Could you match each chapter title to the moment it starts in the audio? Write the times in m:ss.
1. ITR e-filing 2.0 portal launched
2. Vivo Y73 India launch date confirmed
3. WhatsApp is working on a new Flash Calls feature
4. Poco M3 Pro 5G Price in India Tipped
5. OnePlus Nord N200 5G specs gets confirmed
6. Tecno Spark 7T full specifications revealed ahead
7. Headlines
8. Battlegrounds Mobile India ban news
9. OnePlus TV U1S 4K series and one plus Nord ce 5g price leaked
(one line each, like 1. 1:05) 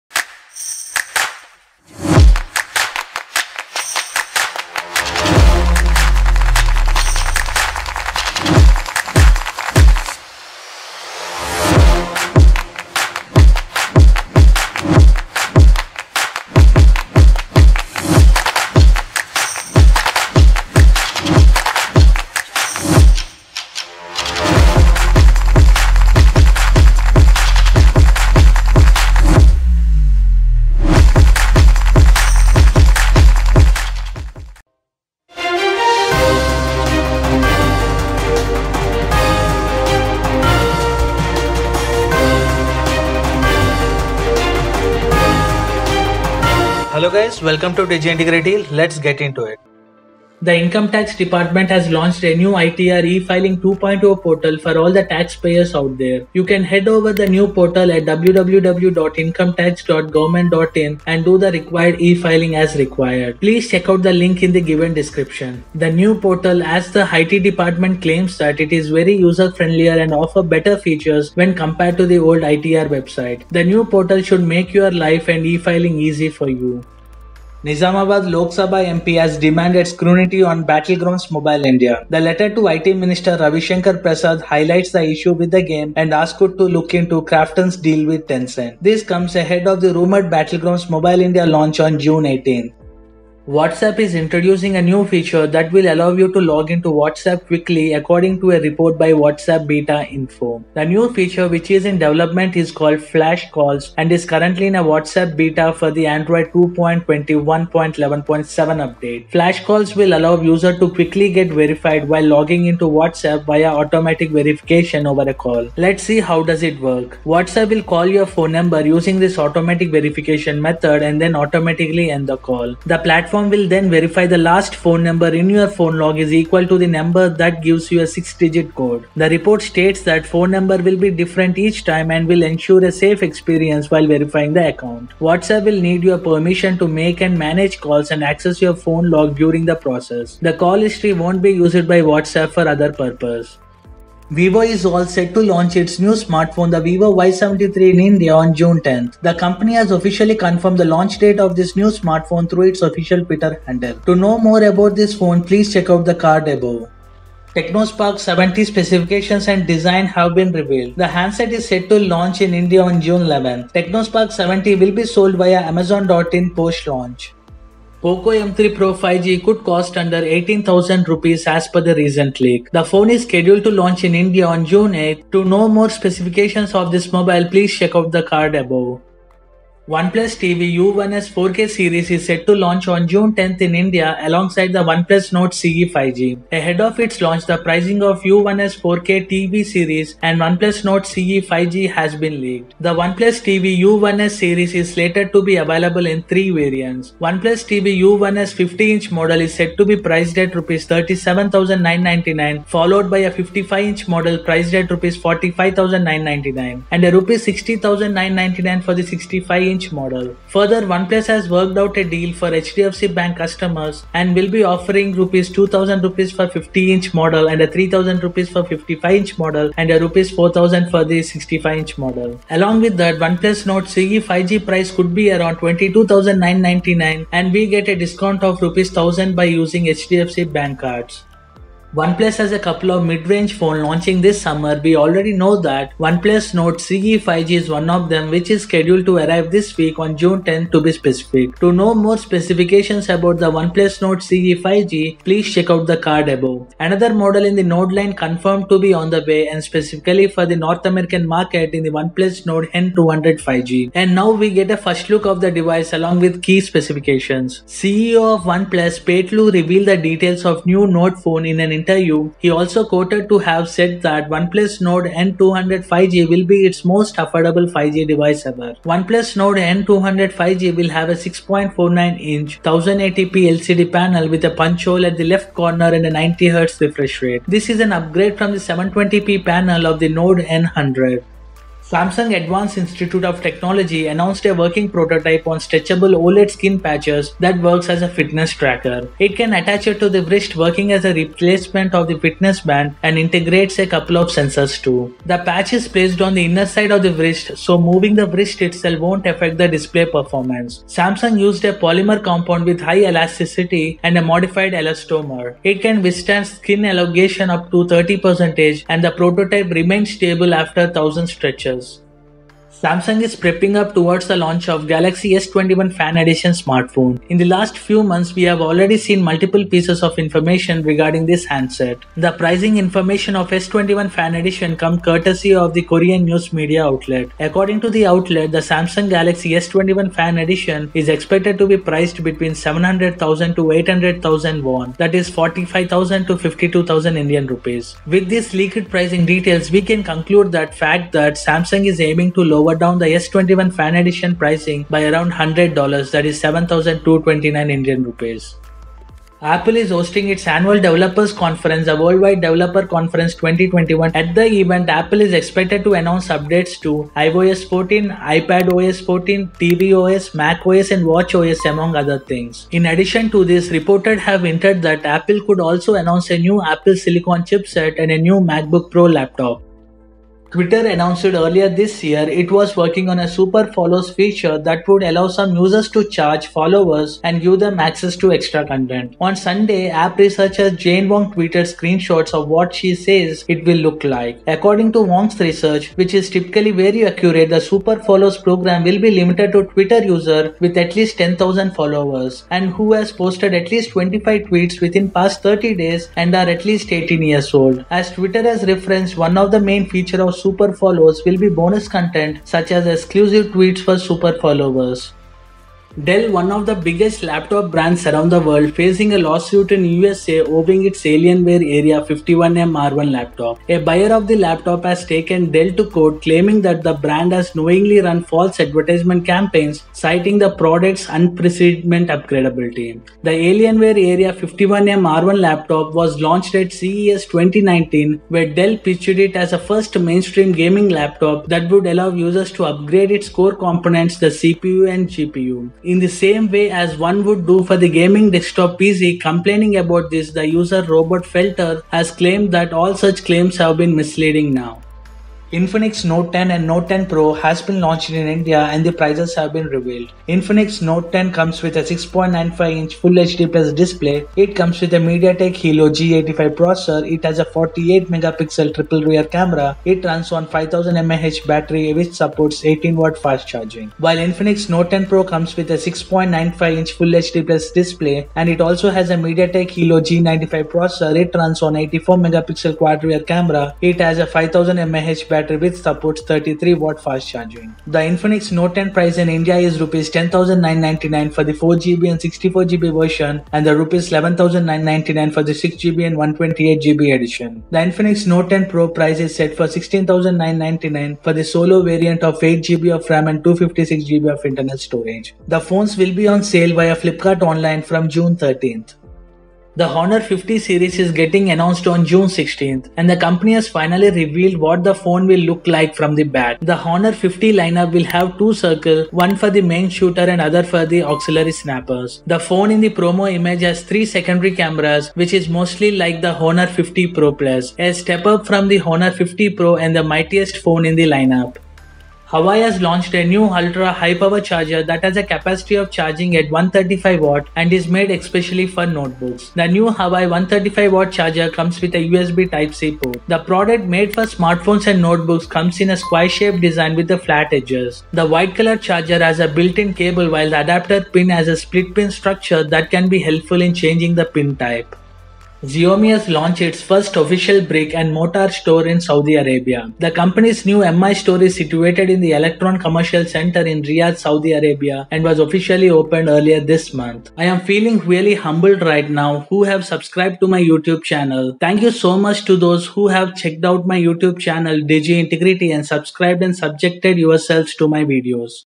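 1. 0:50
2. 2:24
3. 1:33
4. 2:48
5. 3:52
6. 2:37
7. 0:34
8. 1:17
9. 3:00.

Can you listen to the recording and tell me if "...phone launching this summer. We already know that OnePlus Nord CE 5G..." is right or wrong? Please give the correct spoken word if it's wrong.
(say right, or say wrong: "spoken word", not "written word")
right.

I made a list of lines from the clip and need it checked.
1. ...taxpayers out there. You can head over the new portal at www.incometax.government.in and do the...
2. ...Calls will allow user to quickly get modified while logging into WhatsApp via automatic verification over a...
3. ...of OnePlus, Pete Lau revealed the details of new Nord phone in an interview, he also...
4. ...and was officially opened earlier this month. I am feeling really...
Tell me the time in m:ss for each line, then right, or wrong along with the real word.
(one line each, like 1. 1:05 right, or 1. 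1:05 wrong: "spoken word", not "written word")
1. 0:55 right
2. 1:49 wrong: "verified", not "modified"
3. 4:18 right
4. 9:15 right.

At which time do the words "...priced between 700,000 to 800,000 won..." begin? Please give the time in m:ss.
5:31.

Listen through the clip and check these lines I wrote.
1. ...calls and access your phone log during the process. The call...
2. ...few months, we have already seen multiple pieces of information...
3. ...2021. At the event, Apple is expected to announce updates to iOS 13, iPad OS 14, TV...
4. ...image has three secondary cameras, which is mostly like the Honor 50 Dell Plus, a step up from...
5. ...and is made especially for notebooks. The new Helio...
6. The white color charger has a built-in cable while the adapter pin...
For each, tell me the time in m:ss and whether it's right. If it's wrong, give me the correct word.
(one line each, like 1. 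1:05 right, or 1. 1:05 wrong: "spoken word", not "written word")
1. 2:17 right
2. 5:17 right
3. 5:53 wrong: "14", not "13"
4. 8:33 wrong: "Pro", not "Dell"
5. 8:47 wrong: "Huawei", not "Helio"
6. 8:58 right.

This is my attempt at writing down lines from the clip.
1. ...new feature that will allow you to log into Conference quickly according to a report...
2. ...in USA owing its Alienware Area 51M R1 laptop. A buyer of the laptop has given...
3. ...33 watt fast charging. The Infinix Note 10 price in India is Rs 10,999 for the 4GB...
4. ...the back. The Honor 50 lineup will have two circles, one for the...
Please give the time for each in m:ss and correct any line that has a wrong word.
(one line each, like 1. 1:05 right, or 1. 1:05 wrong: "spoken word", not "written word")
1. 1:34 wrong: "WhatsApp", not "Conference"
2. 6:49 wrong: "taken", not "given"
3. 7:56 right
4. 8:26 right.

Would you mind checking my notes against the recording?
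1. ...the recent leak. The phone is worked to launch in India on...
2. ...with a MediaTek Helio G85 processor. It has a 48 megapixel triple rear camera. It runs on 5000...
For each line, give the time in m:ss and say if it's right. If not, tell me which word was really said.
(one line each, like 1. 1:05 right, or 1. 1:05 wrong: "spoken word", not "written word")
1. 2:51 wrong: "scheduled", not "worked"
2. 7:34 right.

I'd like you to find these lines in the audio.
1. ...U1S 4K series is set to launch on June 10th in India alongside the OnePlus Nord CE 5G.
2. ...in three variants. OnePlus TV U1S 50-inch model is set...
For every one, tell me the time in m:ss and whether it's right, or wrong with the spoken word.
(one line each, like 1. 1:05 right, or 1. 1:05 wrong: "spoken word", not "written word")
1. 3:00 right
2. 3:16 right.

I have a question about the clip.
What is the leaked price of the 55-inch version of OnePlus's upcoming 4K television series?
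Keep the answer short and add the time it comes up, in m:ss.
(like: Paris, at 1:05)
Rs 45,999, at 3:25.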